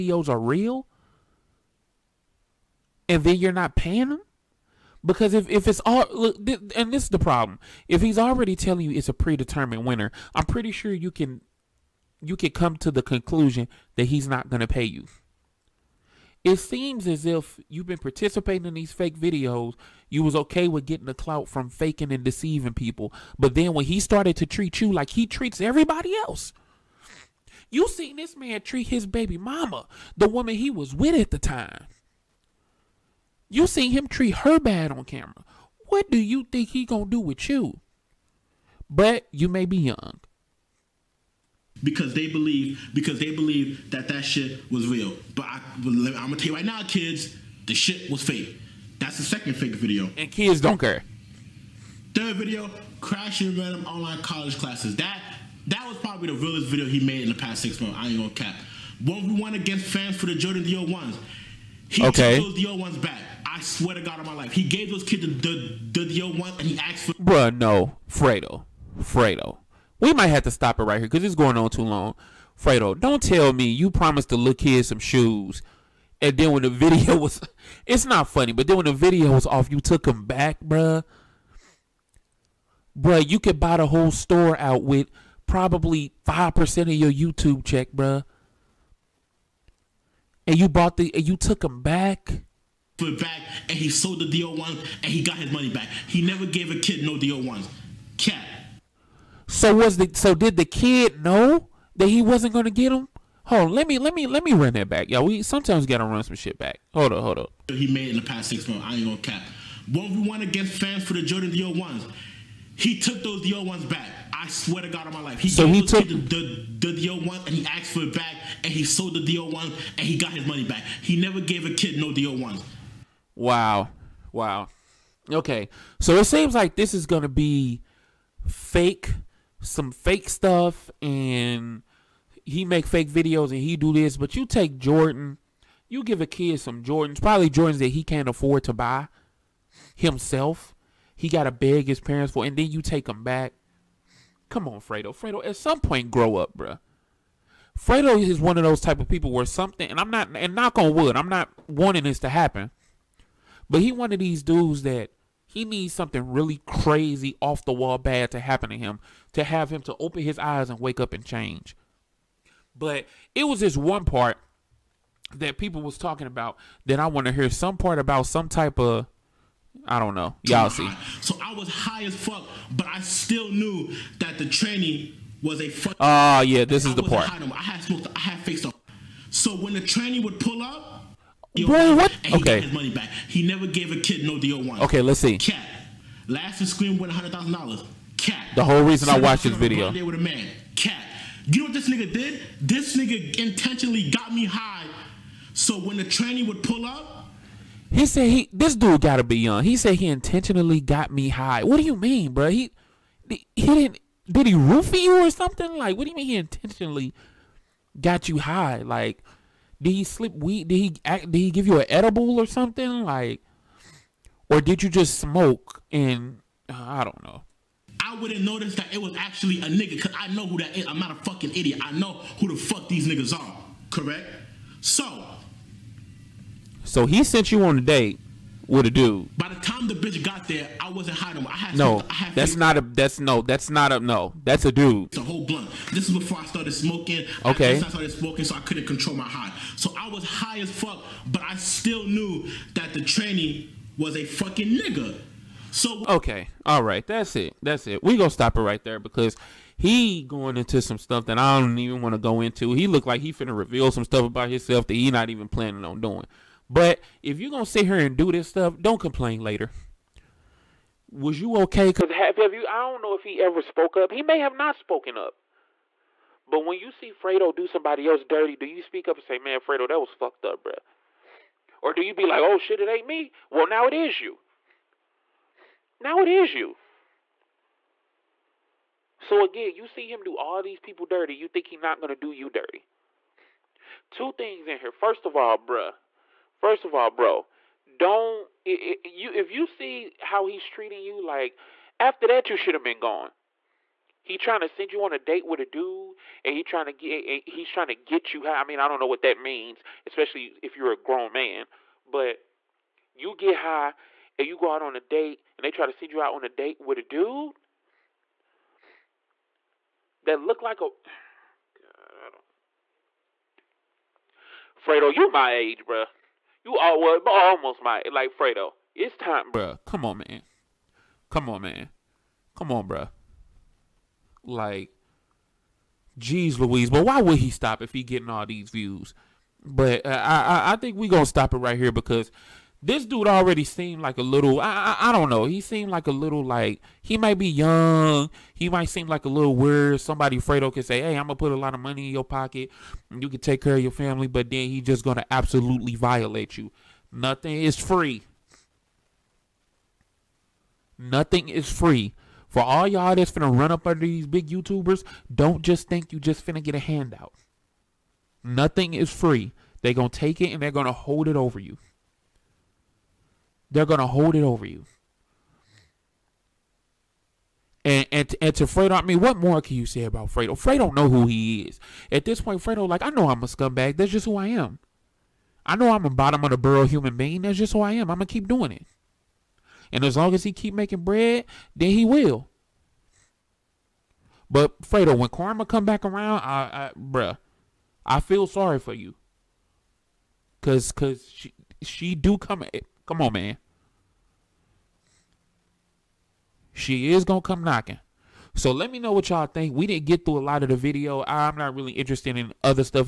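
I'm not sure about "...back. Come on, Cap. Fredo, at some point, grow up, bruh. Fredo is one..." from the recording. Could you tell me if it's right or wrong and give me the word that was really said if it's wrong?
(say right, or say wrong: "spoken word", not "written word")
wrong: "Fredo", not "Cap".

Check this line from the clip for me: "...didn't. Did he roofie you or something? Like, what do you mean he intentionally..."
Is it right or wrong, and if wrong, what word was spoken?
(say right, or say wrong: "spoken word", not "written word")
right.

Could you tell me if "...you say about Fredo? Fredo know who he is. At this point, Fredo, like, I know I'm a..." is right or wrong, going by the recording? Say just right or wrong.
right.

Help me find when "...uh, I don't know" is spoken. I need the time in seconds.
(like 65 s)
216 s.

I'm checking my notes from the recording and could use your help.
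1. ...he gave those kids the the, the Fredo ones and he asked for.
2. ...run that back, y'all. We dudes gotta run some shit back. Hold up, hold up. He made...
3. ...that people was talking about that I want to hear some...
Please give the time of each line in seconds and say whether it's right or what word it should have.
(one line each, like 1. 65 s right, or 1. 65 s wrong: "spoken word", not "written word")
1. 64 s wrong: "Dior", not "Fredo"
2. 104 s wrong: "sometimes", not "dudes"
3. 165 s right.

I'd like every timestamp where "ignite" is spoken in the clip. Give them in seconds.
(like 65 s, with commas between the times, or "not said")
not said.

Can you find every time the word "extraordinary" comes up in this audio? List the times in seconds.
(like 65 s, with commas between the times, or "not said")
not said.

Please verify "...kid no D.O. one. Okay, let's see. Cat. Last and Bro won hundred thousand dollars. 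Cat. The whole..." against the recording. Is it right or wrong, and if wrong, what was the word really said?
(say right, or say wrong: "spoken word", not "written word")
wrong: "Scream", not "Bro".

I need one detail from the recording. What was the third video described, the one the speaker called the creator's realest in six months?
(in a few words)
Crashing random online college classes.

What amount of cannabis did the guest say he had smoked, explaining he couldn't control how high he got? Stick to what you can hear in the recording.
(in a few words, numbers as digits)
A whole blunt.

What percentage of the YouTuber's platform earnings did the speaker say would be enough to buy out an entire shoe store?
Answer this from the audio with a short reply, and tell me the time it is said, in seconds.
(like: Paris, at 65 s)
5%, at 86 s.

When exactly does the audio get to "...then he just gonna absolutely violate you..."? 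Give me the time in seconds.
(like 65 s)
344 s.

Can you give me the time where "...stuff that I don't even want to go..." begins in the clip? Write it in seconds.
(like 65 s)
250 s.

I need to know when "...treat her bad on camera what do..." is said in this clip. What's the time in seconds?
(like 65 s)
34 s.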